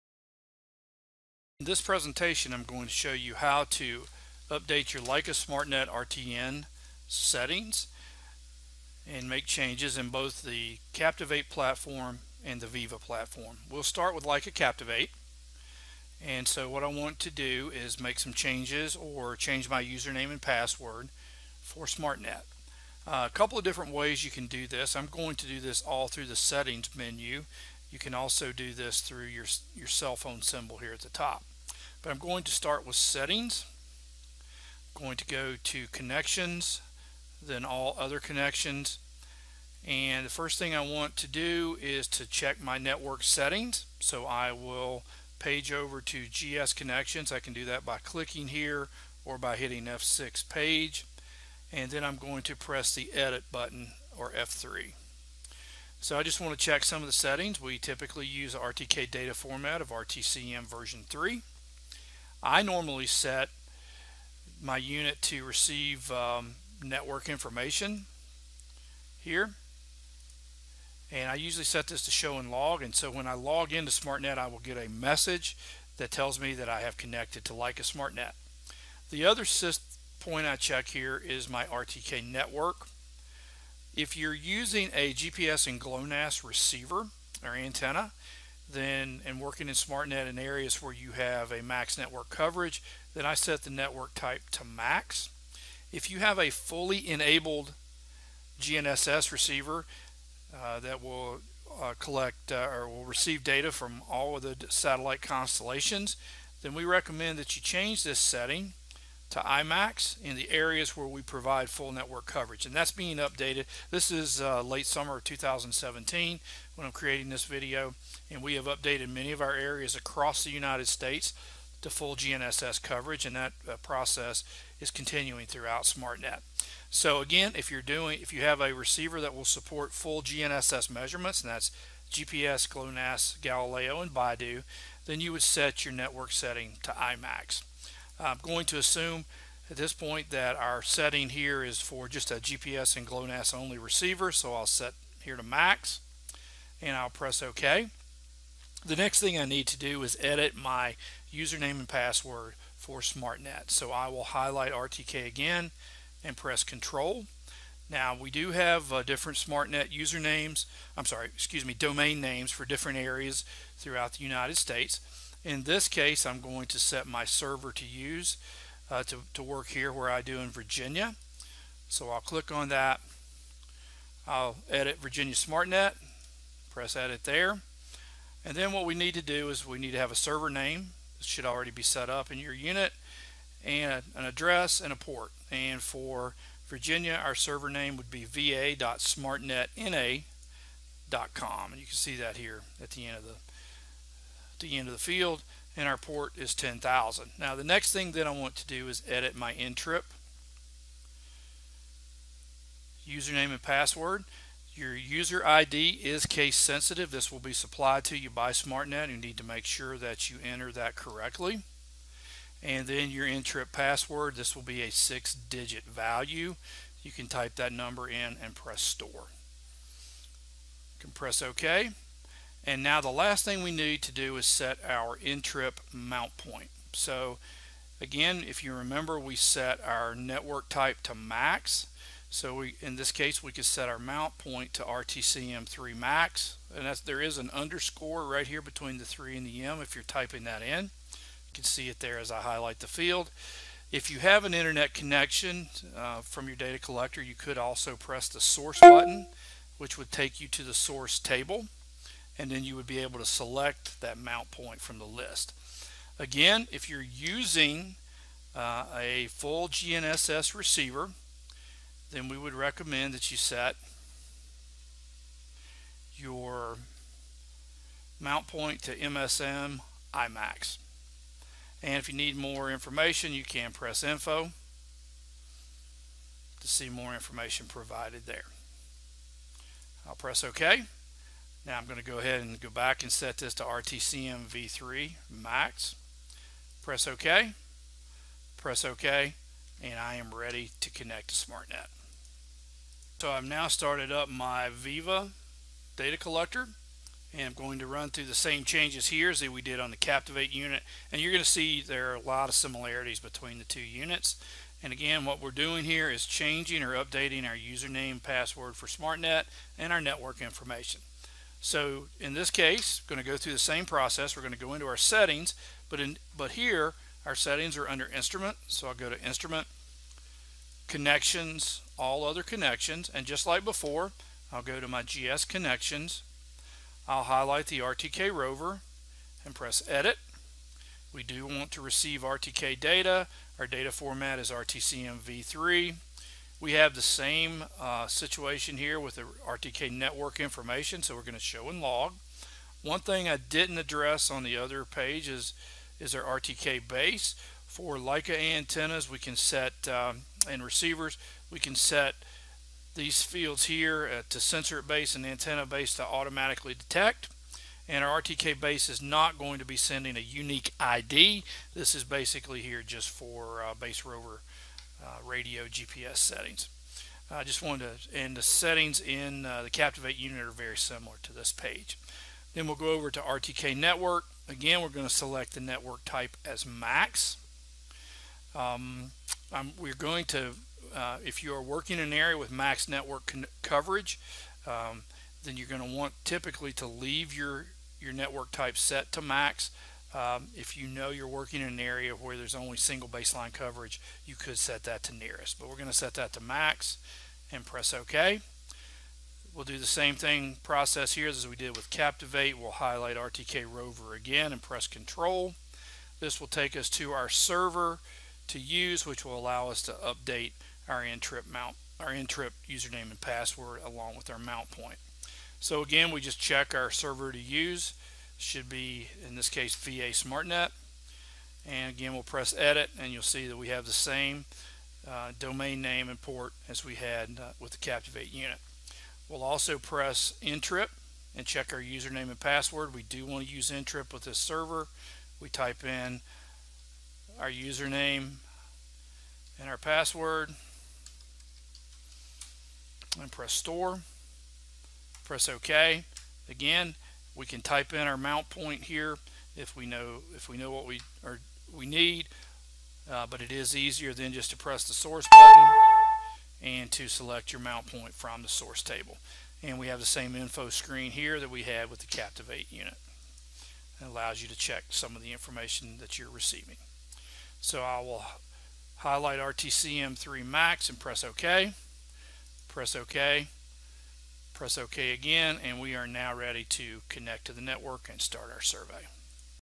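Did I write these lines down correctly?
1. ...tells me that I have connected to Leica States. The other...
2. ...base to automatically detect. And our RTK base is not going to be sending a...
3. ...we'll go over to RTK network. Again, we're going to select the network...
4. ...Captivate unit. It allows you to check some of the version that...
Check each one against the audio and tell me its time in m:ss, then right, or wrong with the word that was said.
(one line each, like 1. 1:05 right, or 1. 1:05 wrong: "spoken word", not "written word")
1. 1:16 wrong: "SmartNet", not "States"
2. 5:55 right
3. 6:12 right
4. 7:42 wrong: "information", not "version".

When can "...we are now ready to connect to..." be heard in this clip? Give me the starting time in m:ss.
7:55.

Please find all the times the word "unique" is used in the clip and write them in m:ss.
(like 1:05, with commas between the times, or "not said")
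6:00.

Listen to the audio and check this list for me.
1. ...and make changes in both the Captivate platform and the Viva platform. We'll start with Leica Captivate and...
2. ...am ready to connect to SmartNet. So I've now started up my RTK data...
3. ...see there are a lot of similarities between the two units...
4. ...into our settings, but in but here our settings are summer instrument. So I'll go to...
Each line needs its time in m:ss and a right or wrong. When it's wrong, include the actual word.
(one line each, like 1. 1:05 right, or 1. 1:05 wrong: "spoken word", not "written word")
1. 0:09 right
2. 4:50 wrong: "Viva", not "RTK"
3. 5:01 right
4. 5:14 wrong: "under", not "summer".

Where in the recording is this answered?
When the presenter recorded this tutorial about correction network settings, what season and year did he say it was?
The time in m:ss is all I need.
1:54.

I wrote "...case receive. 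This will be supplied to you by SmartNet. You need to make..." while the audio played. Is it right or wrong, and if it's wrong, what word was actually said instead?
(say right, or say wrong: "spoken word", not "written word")
wrong: "sensitive", not "receive".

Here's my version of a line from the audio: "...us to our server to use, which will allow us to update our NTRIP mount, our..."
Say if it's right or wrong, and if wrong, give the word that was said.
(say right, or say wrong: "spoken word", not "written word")
right.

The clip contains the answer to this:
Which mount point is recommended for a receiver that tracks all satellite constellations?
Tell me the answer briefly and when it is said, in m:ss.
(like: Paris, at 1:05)
MSM IMAX, at 4:28.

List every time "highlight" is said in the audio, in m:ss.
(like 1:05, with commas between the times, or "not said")
2:34, 4:02, 5:27, 6:42, 7:48.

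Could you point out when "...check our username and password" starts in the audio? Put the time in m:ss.
7:11.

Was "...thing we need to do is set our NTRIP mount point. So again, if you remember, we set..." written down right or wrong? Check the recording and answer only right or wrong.
right.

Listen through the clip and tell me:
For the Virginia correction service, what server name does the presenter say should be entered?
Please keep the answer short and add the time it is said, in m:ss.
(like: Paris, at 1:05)
va.smartnetna.com, at 3:08.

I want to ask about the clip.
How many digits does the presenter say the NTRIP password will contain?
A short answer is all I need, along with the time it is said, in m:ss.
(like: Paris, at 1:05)
6, at 3:34.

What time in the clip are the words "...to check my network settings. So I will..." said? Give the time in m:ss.
0:42.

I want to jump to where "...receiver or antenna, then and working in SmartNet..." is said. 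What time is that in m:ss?
1:26.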